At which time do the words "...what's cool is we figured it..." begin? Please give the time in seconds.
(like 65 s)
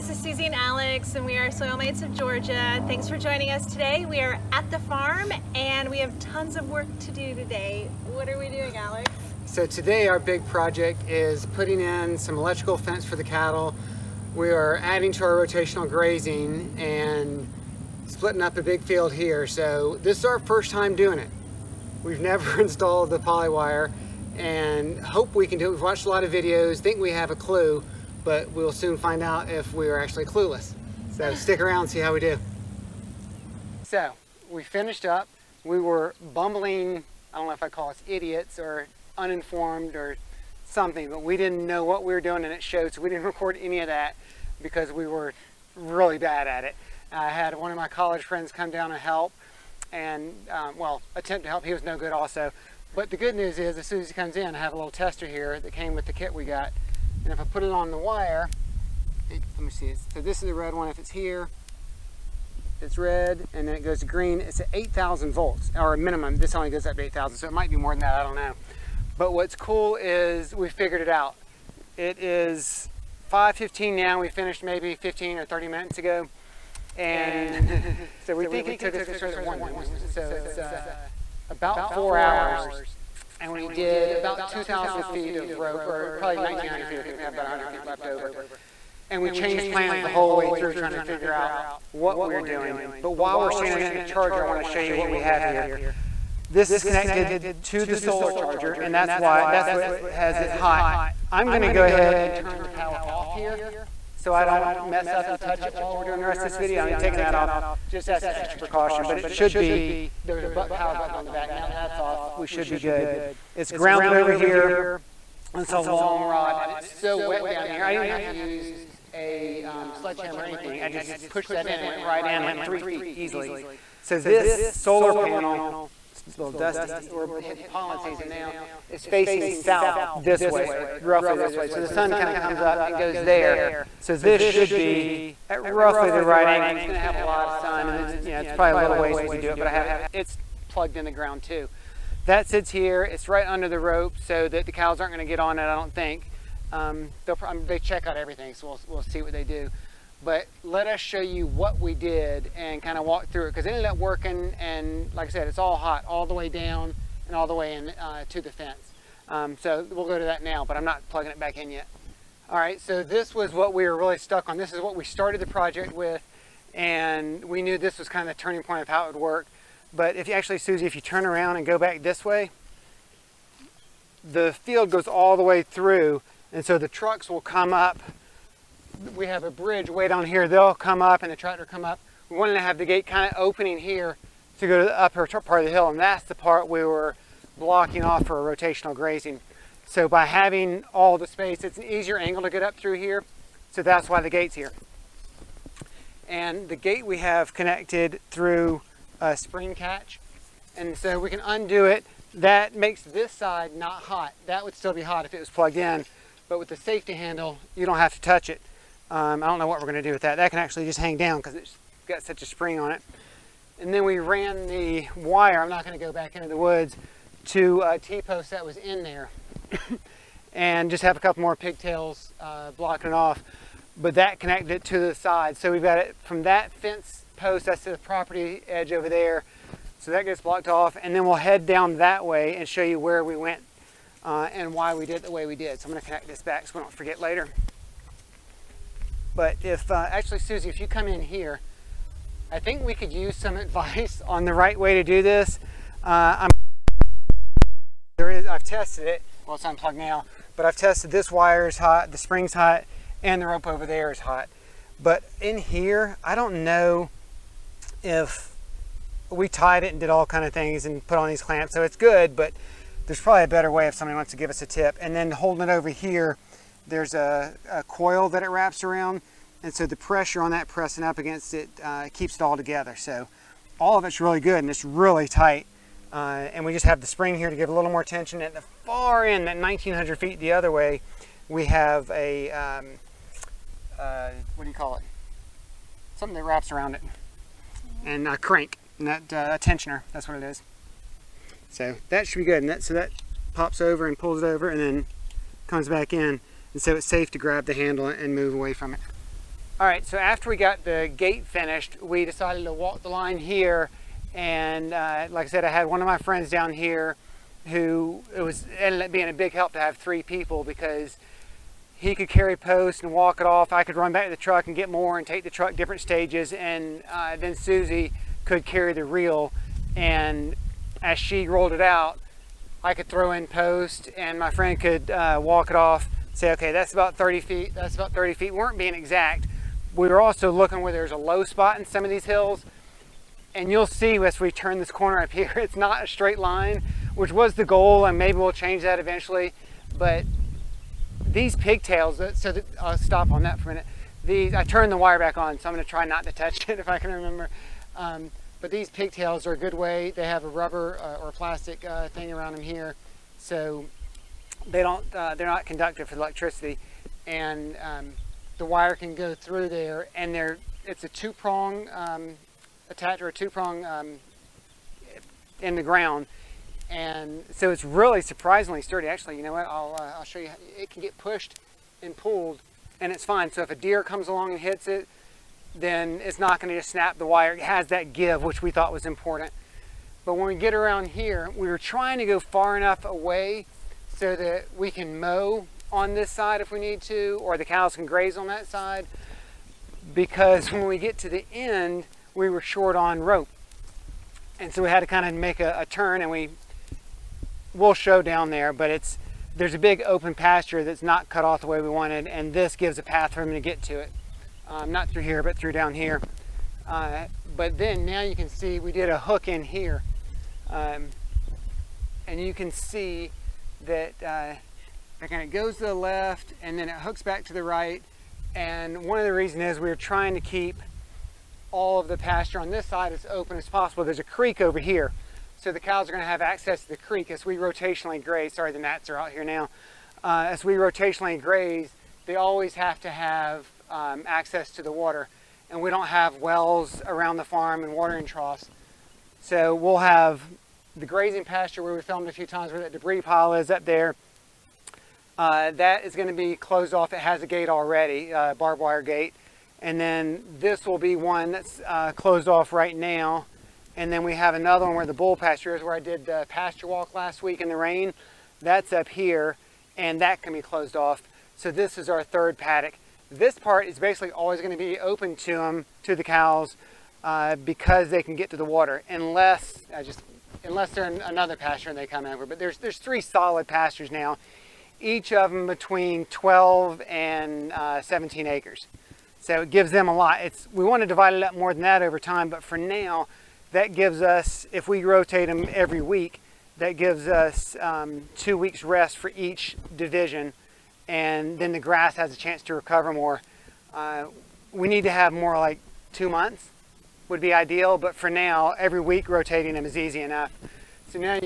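69 s.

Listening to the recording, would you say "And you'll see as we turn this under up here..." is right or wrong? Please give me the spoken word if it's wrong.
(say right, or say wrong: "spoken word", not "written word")
wrong: "corner", not "under".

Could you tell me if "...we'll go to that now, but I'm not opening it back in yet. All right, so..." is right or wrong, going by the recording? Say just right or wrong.
wrong.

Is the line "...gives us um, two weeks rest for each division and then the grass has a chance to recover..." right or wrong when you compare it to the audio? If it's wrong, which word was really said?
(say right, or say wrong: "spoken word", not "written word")
right.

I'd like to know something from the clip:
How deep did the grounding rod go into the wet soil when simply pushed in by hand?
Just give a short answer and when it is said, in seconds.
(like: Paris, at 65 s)
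three feet, at 122 s.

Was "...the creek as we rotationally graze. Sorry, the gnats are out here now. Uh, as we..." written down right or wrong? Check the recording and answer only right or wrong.
right.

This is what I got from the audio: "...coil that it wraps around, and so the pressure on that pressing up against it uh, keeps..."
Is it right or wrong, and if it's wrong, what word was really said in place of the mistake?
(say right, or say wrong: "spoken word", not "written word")
right.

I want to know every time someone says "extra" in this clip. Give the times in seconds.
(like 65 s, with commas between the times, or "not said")
108 s.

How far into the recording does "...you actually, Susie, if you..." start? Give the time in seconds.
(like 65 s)
170 s.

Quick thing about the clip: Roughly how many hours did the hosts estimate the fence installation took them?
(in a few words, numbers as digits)
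four hours.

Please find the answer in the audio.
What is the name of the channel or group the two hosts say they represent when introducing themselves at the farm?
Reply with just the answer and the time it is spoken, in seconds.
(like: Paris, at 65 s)
Soilmates of Georgia, at 1 s.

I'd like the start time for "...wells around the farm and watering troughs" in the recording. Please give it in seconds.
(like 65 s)
436 s.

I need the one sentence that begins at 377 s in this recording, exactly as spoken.
It has that give, which we thought was important.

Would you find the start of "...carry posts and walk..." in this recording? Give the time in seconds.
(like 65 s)
312 s.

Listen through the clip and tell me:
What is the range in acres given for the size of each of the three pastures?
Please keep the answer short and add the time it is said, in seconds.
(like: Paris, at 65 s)
12 to 17 acres, at 476 s.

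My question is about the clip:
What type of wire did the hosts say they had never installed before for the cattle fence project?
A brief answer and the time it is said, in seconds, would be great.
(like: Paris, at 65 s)
polywire, at 23 s.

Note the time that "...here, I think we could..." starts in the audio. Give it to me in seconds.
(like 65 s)
241 s.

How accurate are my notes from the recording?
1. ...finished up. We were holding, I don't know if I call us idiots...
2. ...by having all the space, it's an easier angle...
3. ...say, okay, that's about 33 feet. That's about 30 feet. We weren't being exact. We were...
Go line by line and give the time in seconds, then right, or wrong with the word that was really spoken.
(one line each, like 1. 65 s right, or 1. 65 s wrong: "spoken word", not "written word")
1. 34 s wrong: "bumbling", not "holding"
2. 190 s right
3. 326 s wrong: "30", not "33".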